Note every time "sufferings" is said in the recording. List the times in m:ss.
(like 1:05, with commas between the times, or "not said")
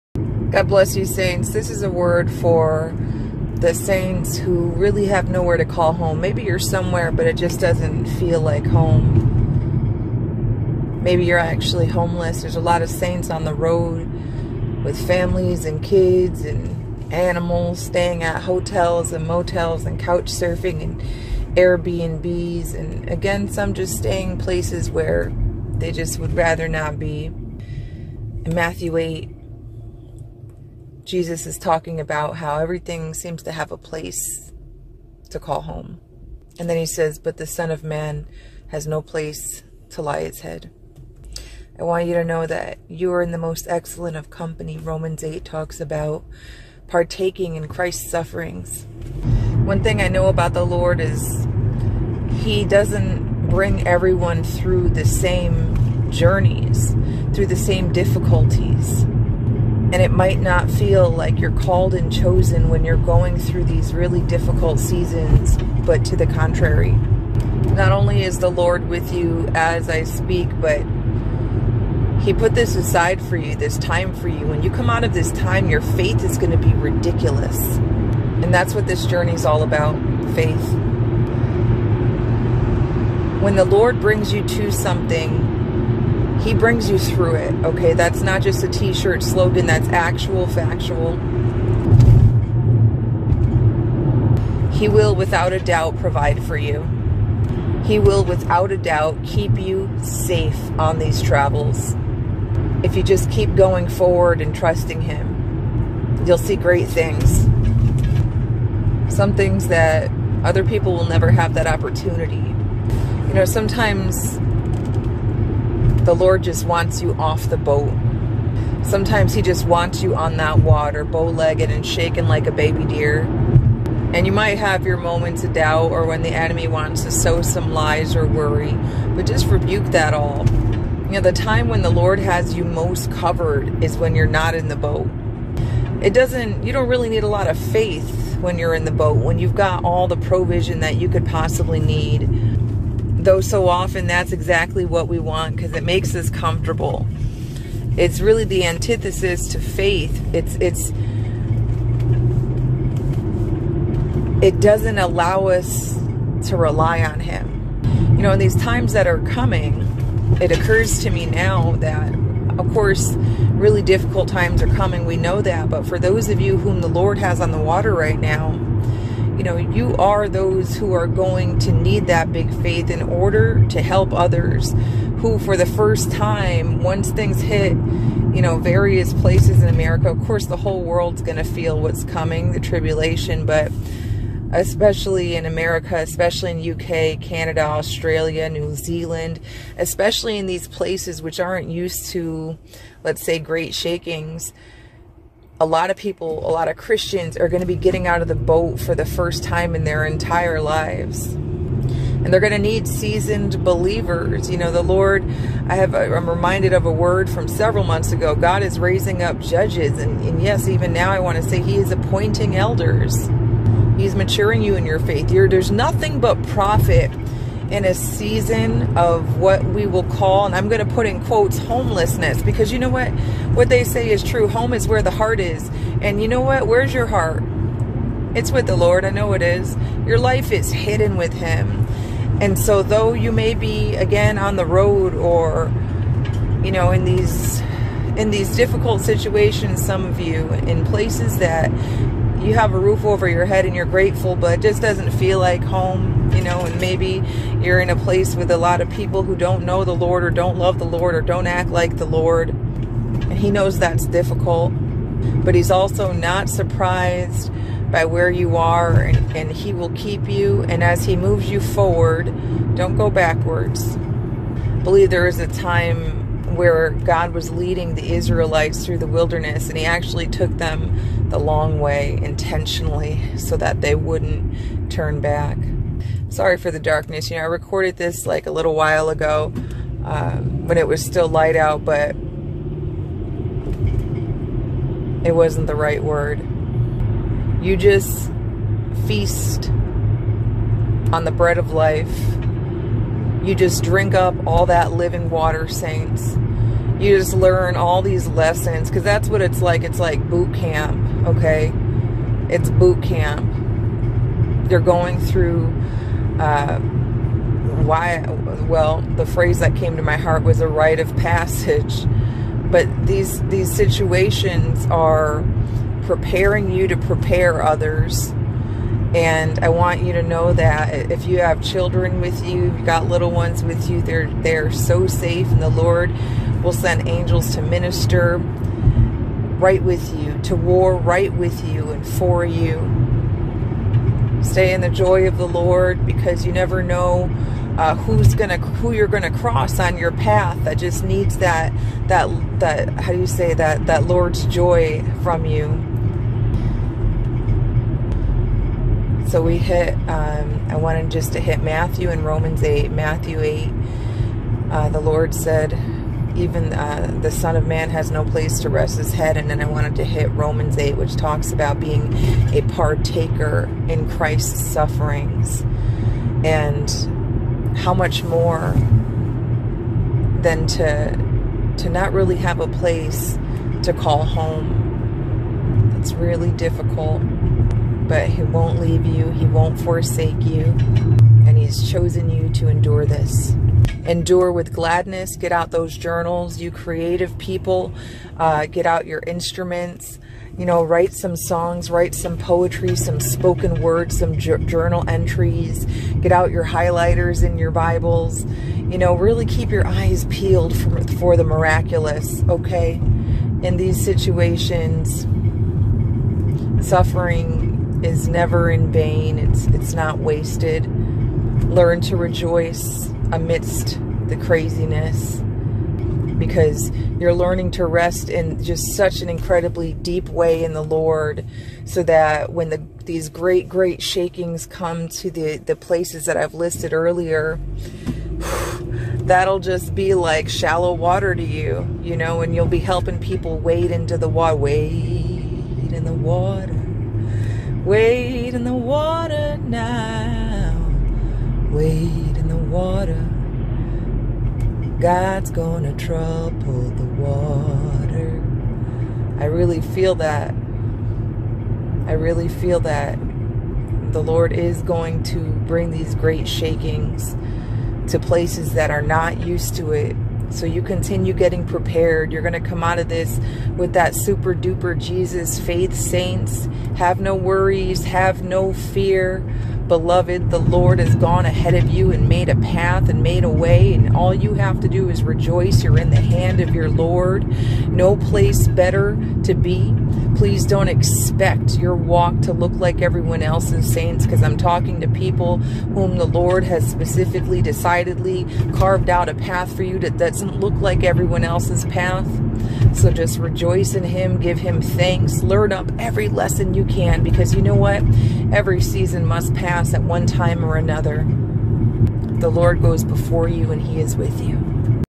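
0:48, 6:04, 6:46.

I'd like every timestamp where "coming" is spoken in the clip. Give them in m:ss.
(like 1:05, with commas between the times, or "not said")
2:39, 2:44, 3:02.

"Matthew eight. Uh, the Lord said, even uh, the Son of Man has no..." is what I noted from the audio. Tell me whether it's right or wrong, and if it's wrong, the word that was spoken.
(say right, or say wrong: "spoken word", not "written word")
right.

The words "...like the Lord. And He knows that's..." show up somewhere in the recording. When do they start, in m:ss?
4:11.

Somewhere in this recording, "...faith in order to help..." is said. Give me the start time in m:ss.
2:52.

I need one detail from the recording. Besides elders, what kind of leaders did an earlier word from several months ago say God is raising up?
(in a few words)
Judges.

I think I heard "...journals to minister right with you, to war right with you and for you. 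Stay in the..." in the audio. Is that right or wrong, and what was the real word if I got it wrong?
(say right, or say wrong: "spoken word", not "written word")
wrong: "angels", not "journals".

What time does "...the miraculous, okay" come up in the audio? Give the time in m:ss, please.
6:41.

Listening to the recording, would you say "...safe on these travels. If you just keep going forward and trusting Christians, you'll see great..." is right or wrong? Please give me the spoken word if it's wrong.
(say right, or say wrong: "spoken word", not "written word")
wrong: "Him", not "Christians".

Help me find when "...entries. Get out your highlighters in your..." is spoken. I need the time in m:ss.
6:35.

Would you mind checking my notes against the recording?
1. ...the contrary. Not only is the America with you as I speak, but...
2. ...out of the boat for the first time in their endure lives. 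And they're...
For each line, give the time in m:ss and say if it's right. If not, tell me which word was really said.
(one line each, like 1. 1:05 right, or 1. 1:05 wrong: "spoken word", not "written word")
1. 1:06 wrong: "Lord", not "America"
2. 3:18 wrong: "entire", not "endure".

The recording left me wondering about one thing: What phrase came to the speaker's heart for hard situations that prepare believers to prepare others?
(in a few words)
A rite of passage.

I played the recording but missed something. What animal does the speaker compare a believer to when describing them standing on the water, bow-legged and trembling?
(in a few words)
A baby deer.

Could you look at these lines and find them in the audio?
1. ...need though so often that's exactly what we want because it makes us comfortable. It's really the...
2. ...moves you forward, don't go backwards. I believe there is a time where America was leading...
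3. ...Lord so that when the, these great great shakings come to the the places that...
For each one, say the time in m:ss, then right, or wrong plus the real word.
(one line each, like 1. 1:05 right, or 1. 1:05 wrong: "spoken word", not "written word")
1. 2:21 right
2. 4:21 wrong: "God", not "America"
3. 7:00 right.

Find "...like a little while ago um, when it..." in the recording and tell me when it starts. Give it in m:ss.
4:38.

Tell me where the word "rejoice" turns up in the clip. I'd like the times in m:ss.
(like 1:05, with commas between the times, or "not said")
6:52, 7:55, 8:13.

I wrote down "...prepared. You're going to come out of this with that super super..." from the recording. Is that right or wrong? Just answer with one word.
wrong.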